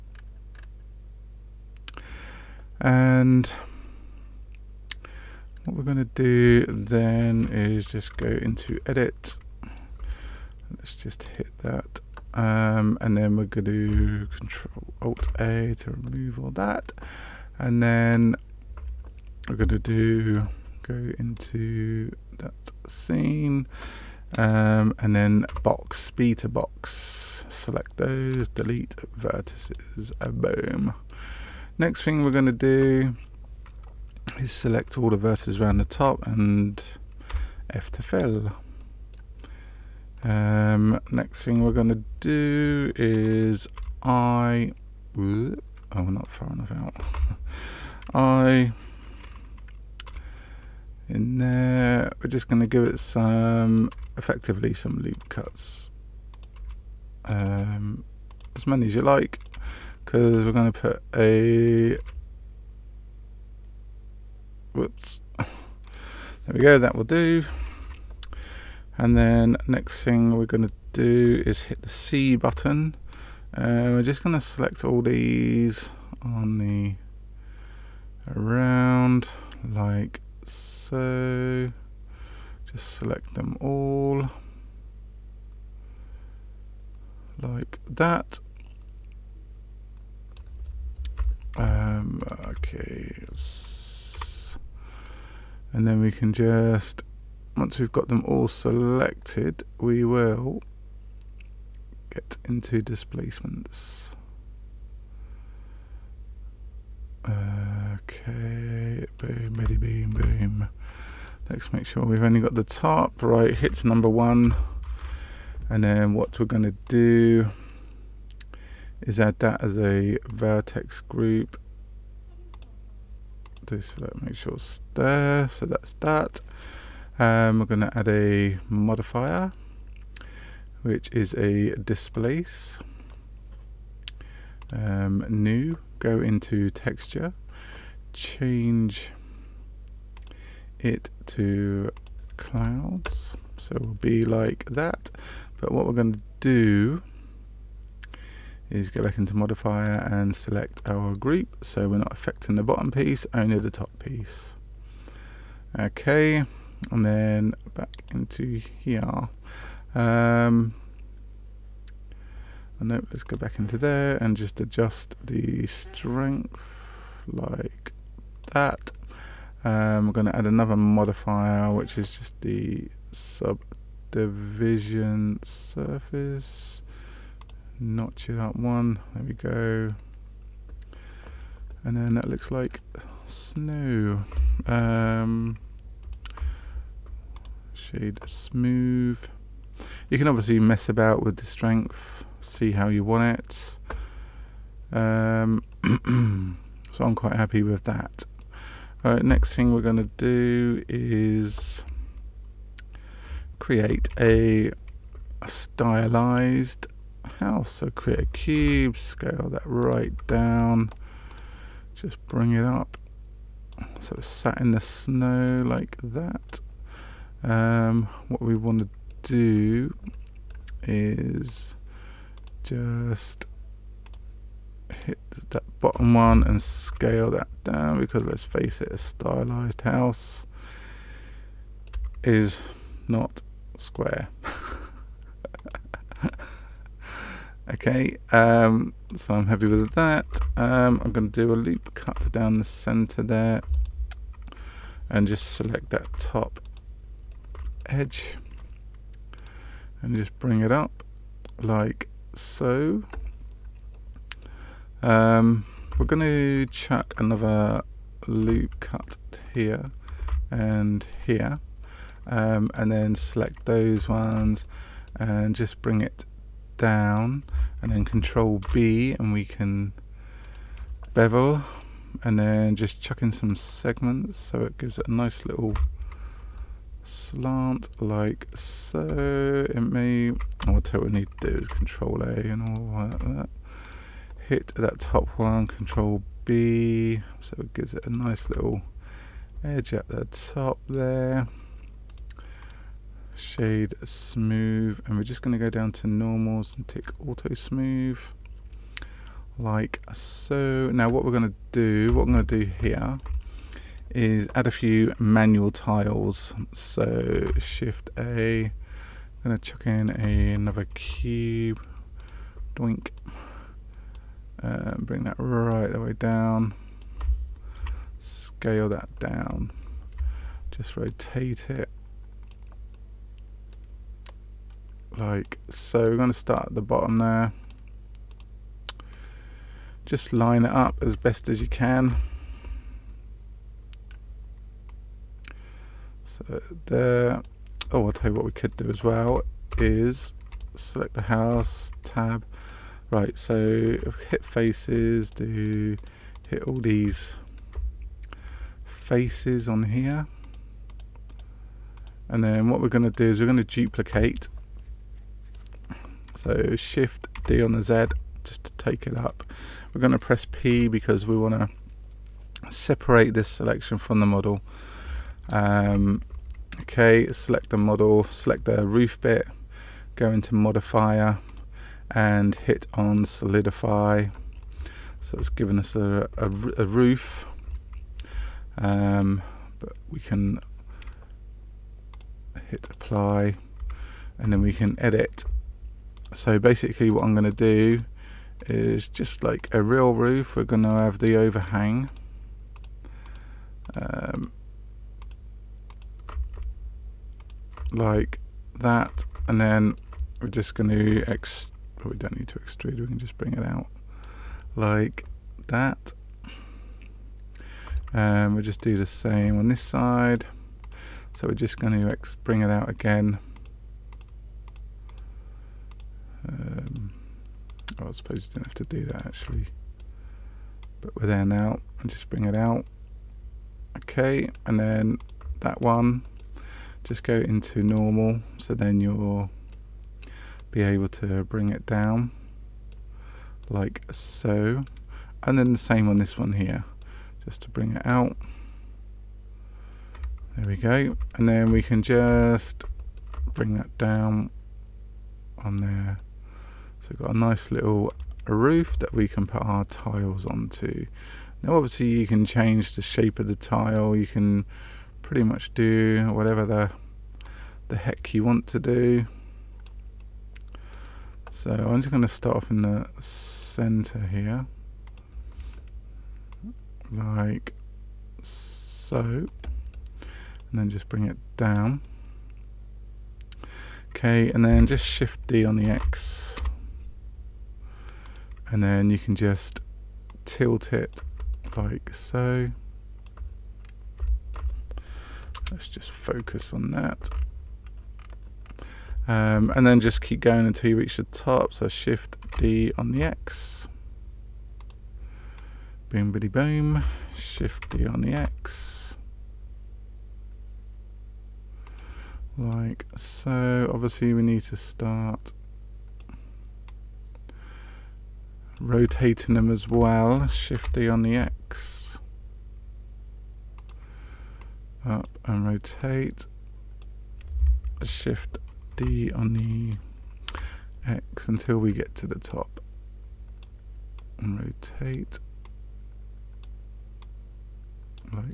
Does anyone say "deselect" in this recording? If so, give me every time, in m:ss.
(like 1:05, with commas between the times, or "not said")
2:03.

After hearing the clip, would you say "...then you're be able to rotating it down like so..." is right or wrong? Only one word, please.
wrong.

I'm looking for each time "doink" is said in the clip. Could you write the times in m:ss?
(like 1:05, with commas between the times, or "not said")
5:12.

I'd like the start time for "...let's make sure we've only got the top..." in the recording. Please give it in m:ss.
1:51.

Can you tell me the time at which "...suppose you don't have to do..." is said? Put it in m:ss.
6:58.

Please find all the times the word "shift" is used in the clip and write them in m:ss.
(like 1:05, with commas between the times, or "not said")
5:07, 5:56, 7:55, 8:11, 8:17, 8:30, 8:38.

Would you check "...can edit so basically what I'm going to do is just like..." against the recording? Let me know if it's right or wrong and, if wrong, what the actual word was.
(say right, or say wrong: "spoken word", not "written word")
right.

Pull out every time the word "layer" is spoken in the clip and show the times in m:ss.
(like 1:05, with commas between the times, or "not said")
not said.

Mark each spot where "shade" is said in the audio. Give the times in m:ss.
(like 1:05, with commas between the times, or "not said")
3:07, 4:53.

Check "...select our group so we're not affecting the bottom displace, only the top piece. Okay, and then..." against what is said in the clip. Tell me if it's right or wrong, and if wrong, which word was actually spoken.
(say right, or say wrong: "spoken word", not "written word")
wrong: "piece", not "displace".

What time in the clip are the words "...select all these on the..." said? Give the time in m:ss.
1:14.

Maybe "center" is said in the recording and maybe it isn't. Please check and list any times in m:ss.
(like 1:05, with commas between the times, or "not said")
4:02, 7:43.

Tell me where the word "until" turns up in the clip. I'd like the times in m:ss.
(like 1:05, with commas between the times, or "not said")
8:10, 8:41.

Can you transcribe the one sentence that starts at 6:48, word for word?
Um, we'll just do the same on this side.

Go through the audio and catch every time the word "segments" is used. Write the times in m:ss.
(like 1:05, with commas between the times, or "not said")
4:33.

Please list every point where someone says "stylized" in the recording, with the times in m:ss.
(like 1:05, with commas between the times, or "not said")
3:25, 3:48.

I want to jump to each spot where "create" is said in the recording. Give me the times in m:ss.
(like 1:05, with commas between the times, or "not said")
3:23, 3:27.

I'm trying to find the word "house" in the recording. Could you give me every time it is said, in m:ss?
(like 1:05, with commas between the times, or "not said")
3:27, 3:49, 5:41.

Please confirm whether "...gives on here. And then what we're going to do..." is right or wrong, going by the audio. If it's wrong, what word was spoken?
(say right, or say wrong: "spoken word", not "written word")
wrong: "faces", not "gives".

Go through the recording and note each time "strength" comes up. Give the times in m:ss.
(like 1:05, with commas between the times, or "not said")
2:45, 3:11.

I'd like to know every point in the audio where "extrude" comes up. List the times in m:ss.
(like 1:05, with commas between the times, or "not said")
6:42.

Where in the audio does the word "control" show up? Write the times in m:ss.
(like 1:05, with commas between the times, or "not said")
0:14, 4:28, 4:41, 4:45.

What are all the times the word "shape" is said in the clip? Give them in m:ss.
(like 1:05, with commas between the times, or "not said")
7:33.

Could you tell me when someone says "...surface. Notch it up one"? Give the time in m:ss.
2:55.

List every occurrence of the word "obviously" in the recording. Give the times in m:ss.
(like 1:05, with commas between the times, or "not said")
3:10, 7:31, 8:23.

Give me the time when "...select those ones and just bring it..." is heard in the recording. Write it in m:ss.
4:23.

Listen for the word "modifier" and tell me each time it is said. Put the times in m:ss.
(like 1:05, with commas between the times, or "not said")
2:08, 2:29, 2:50, 6:10.